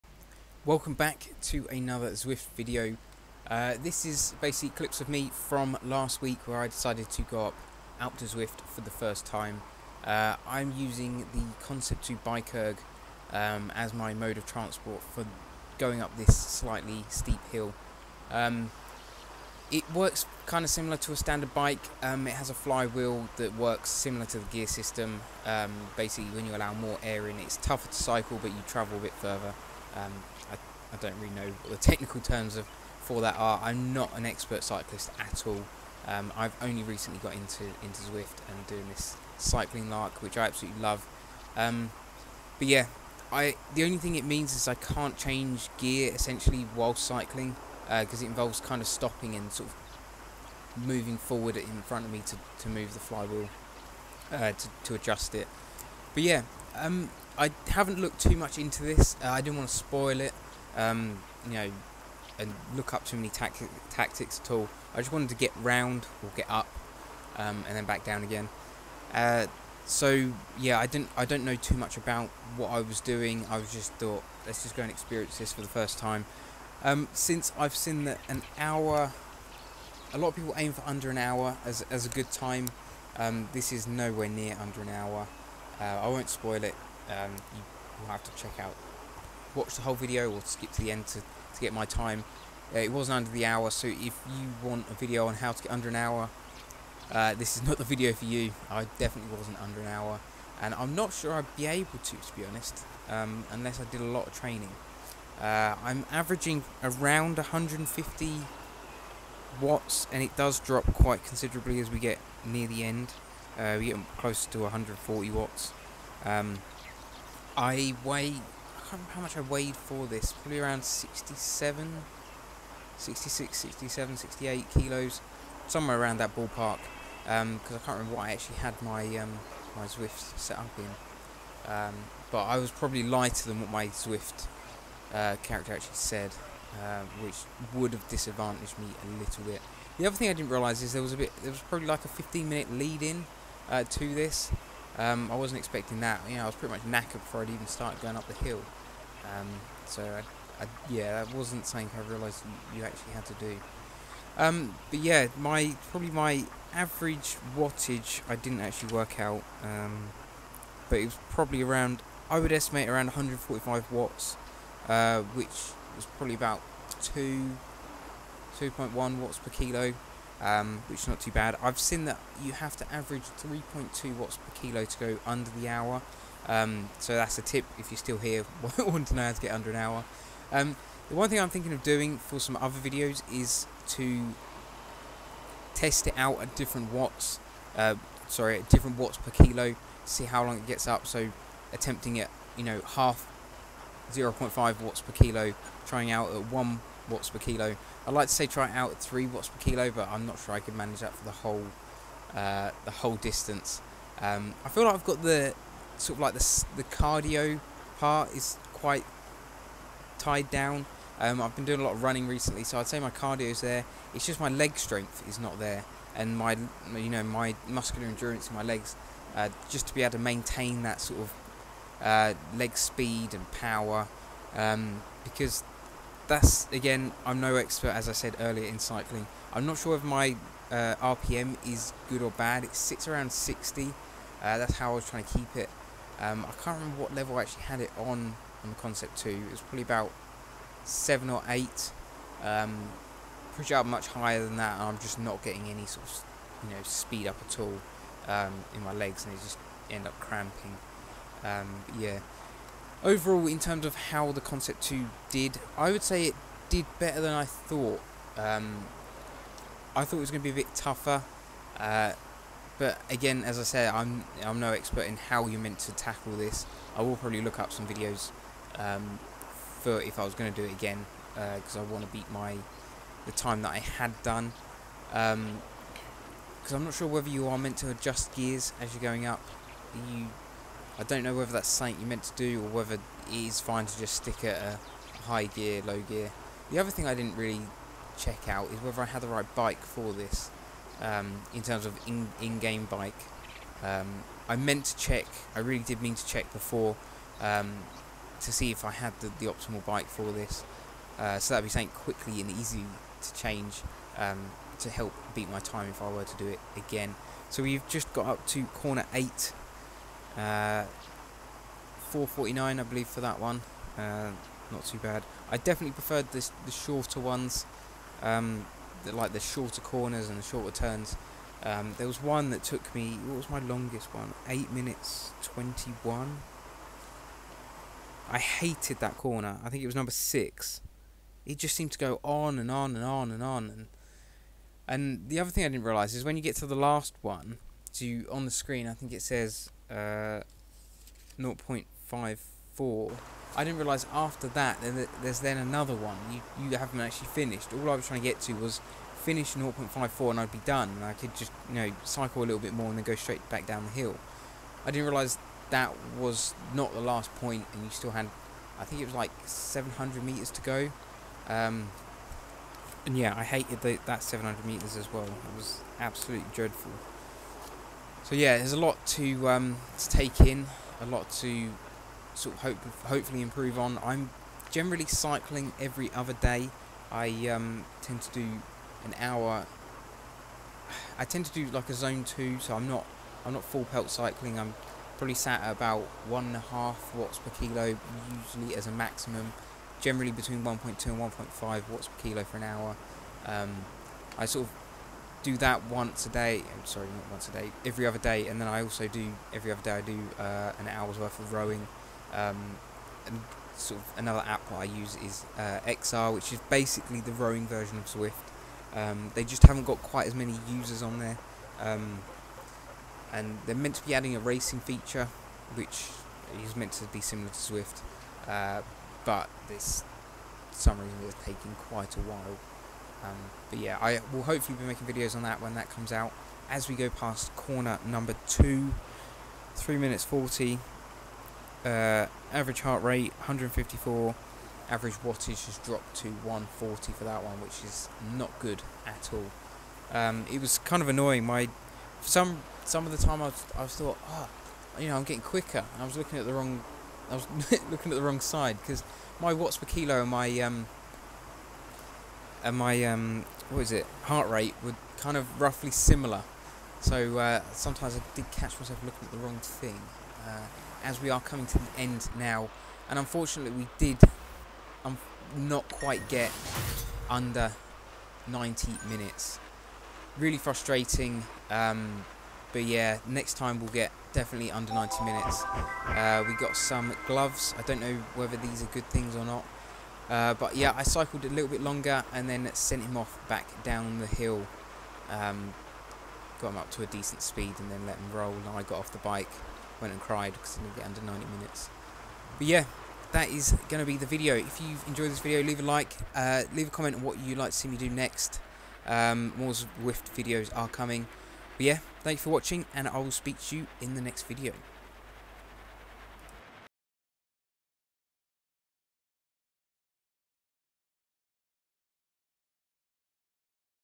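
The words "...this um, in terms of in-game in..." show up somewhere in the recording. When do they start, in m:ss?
4:50.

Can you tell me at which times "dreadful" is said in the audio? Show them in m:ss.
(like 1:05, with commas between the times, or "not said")
6:06.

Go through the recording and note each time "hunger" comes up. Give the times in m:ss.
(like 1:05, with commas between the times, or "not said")
not said.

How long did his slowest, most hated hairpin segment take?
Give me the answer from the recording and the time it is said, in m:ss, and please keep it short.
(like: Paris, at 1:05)
8 minutes 21, at 5:24.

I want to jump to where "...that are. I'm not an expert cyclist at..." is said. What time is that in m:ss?
0:33.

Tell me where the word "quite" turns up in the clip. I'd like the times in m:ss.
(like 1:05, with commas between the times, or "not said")
1:50, 3:28, 6:50, 7:01, 7:45.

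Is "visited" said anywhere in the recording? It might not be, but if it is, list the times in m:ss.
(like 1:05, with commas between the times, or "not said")
not said.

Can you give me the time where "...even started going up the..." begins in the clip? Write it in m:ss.
2:27.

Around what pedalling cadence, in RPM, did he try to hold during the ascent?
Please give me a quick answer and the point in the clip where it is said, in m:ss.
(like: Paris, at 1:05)
60, at 3:53.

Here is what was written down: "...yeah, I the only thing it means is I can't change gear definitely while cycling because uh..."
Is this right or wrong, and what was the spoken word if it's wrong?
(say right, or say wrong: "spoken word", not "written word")
wrong: "essentially", not "definitely".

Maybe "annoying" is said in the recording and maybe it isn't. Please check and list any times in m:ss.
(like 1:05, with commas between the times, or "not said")
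7:21.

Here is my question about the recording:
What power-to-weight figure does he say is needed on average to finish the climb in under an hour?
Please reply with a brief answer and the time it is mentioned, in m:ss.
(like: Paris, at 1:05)
3.2 watts per kilo, at 2:53.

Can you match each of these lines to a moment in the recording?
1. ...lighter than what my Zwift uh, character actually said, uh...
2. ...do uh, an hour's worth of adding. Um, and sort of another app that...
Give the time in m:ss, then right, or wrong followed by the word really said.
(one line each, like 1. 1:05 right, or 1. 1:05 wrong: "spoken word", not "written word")
1. 2:13 right
2. 6:40 wrong: "rowing", not "adding".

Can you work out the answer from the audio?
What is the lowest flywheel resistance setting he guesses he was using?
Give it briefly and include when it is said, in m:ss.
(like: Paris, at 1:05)
7, at 4:00.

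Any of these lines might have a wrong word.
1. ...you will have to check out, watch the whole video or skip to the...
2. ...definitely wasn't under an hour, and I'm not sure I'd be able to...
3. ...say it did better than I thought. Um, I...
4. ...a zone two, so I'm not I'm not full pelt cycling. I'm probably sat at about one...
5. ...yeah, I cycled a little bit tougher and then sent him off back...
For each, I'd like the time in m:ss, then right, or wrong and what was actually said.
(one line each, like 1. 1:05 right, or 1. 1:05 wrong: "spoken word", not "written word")
1. 1:27 right
2. 1:38 right
3. 4:16 right
4. 6:21 right
5. 8:00 wrong: "longer", not "tougher".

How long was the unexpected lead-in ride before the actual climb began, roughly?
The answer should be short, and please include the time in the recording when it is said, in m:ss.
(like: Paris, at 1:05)
15 minutes, at 2:22.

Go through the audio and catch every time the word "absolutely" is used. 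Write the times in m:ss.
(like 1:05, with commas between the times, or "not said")
0:40, 6:05.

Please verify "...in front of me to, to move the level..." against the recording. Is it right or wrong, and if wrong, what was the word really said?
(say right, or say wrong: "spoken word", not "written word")
wrong: "flywheel", not "level".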